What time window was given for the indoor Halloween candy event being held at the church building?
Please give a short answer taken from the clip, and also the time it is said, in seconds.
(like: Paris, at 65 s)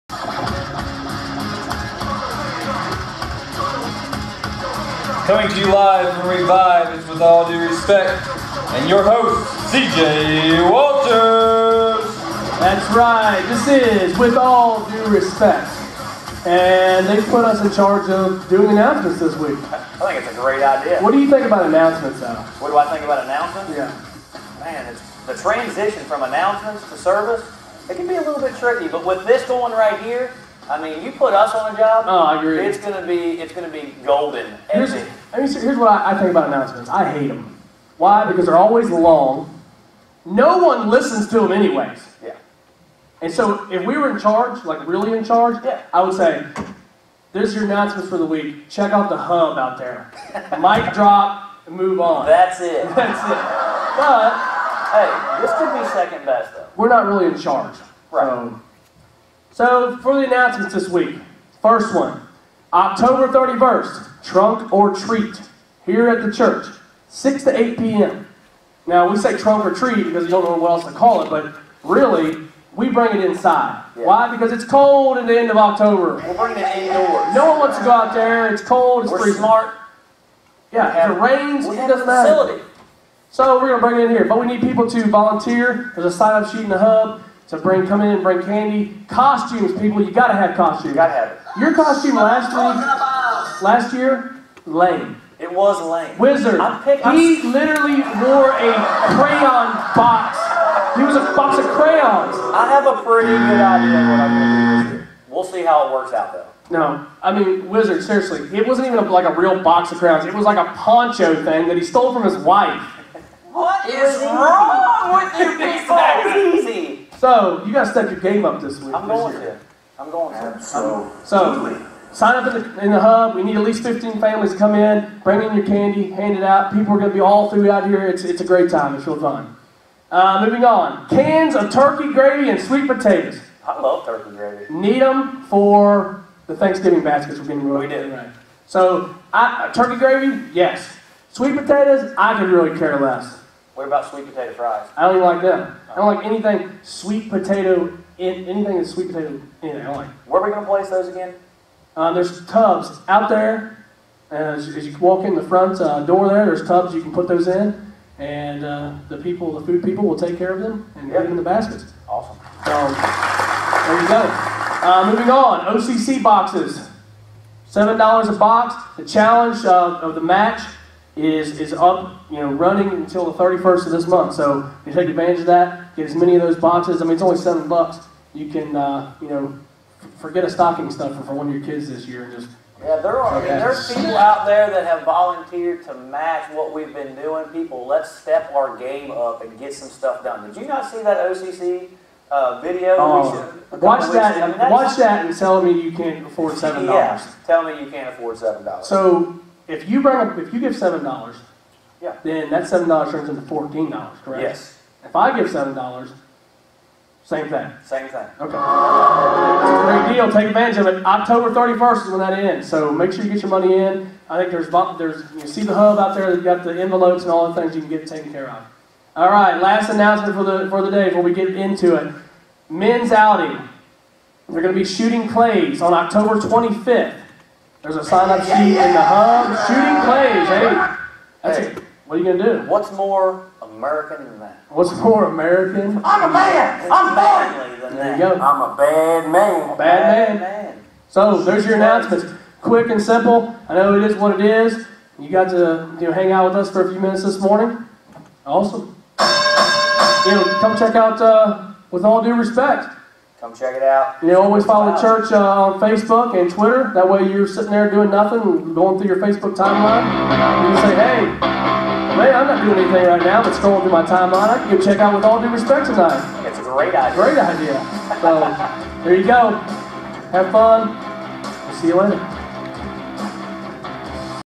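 6 to 8 p.m., at 67 s.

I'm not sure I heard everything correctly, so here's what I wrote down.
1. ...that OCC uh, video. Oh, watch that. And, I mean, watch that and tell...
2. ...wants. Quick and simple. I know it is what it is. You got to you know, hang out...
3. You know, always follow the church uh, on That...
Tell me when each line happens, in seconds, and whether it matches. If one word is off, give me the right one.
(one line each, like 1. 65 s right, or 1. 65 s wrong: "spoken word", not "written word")
1. 191 s right
2. 241 s wrong: "announcements", not "wants"
3. 254 s wrong: "Facebook", not "That".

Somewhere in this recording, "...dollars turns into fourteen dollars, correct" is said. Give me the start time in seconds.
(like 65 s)
202 s.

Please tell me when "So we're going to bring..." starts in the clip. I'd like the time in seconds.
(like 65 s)
83 s.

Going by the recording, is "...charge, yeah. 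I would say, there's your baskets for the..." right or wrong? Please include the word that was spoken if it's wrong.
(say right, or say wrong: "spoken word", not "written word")
wrong: "announcements", not "baskets".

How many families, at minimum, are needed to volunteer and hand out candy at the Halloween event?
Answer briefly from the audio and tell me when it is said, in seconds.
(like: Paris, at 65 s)
15, at 123 s.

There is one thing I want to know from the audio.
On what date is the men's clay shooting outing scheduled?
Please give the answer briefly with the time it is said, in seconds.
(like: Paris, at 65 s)
October 25th, at 225 s.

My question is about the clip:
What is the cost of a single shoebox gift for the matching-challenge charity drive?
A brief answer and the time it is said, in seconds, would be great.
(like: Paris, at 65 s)
$7, at 167 s.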